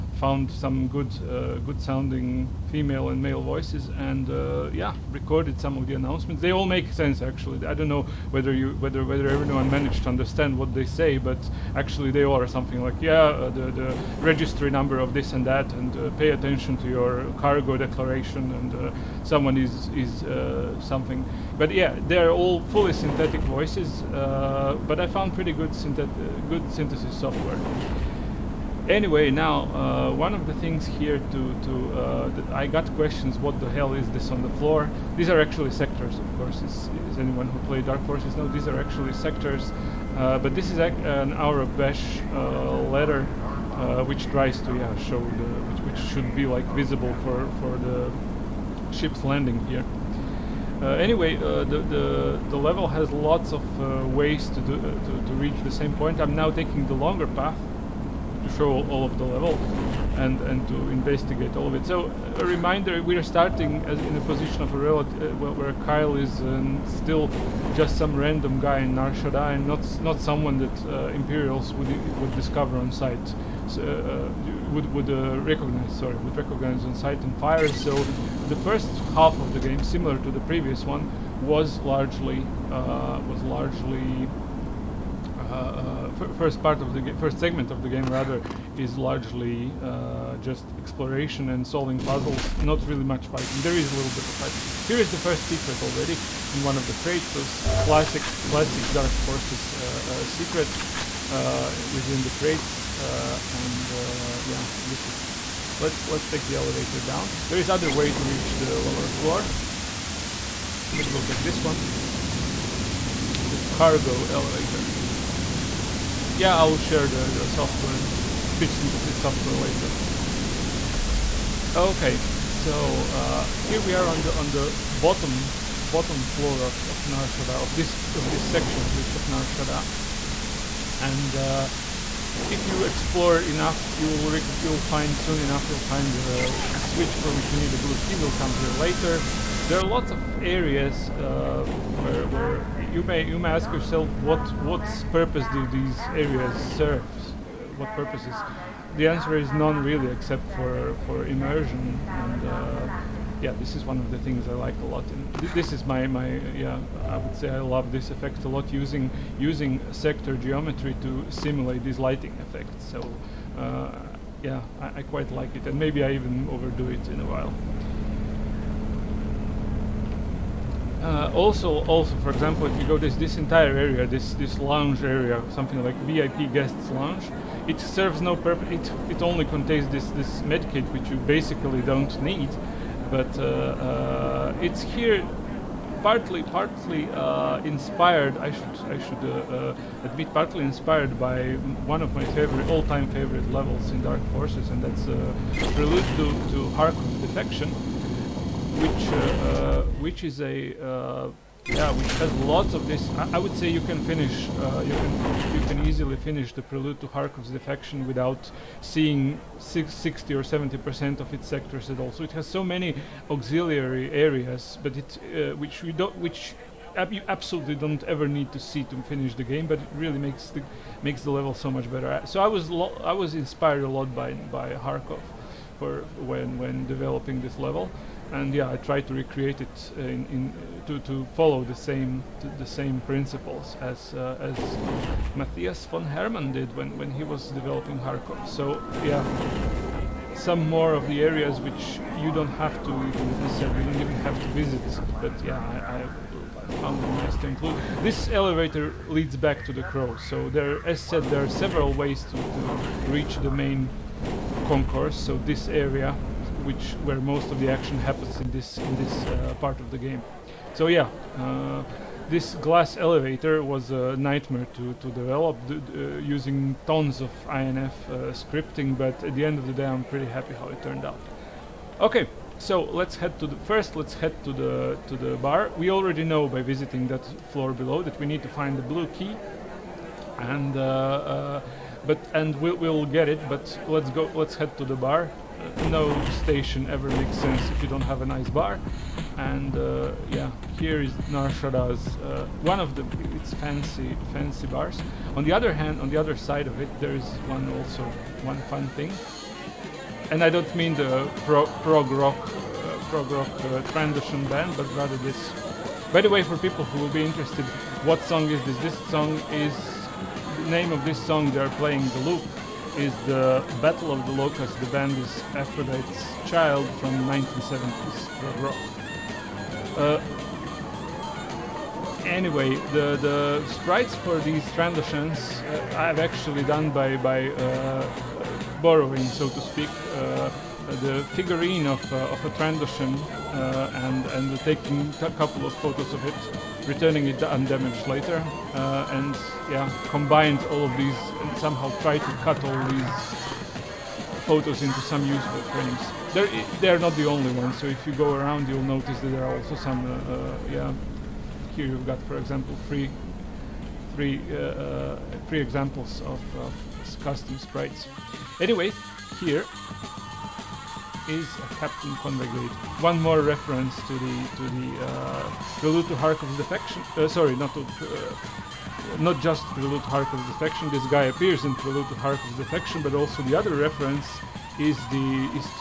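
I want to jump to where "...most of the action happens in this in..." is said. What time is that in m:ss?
4:17.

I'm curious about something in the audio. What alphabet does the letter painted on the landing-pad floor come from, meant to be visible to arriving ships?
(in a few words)
Aurebesh.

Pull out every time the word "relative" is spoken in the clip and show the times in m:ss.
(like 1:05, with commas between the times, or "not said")
1:04.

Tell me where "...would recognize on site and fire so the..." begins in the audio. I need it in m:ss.
1:16.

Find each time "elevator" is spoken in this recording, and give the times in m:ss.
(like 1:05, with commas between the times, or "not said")
1:46, 1:54, 4:08, 4:22.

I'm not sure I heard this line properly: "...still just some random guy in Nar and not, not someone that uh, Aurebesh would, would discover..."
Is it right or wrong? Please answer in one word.
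wrong.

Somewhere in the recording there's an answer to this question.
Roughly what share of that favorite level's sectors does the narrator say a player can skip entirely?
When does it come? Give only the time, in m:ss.
3:29.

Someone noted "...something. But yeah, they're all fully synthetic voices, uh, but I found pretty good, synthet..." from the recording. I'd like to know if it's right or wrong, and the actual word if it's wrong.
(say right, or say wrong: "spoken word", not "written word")
right.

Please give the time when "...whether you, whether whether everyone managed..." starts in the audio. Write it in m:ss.
0:08.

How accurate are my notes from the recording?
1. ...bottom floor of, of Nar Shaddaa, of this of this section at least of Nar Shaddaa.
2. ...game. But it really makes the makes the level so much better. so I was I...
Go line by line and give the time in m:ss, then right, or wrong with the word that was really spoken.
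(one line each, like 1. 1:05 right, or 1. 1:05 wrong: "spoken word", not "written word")
1. 2:05 right
2. 3:39 right.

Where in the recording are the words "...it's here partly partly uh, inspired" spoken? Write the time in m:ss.
3:04.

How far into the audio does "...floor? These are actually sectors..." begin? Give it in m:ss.
0:34.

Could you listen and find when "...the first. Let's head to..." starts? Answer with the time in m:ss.
4:33.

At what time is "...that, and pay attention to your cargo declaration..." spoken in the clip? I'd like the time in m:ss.
0:15.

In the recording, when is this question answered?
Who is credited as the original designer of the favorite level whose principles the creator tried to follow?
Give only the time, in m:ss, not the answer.
3:55.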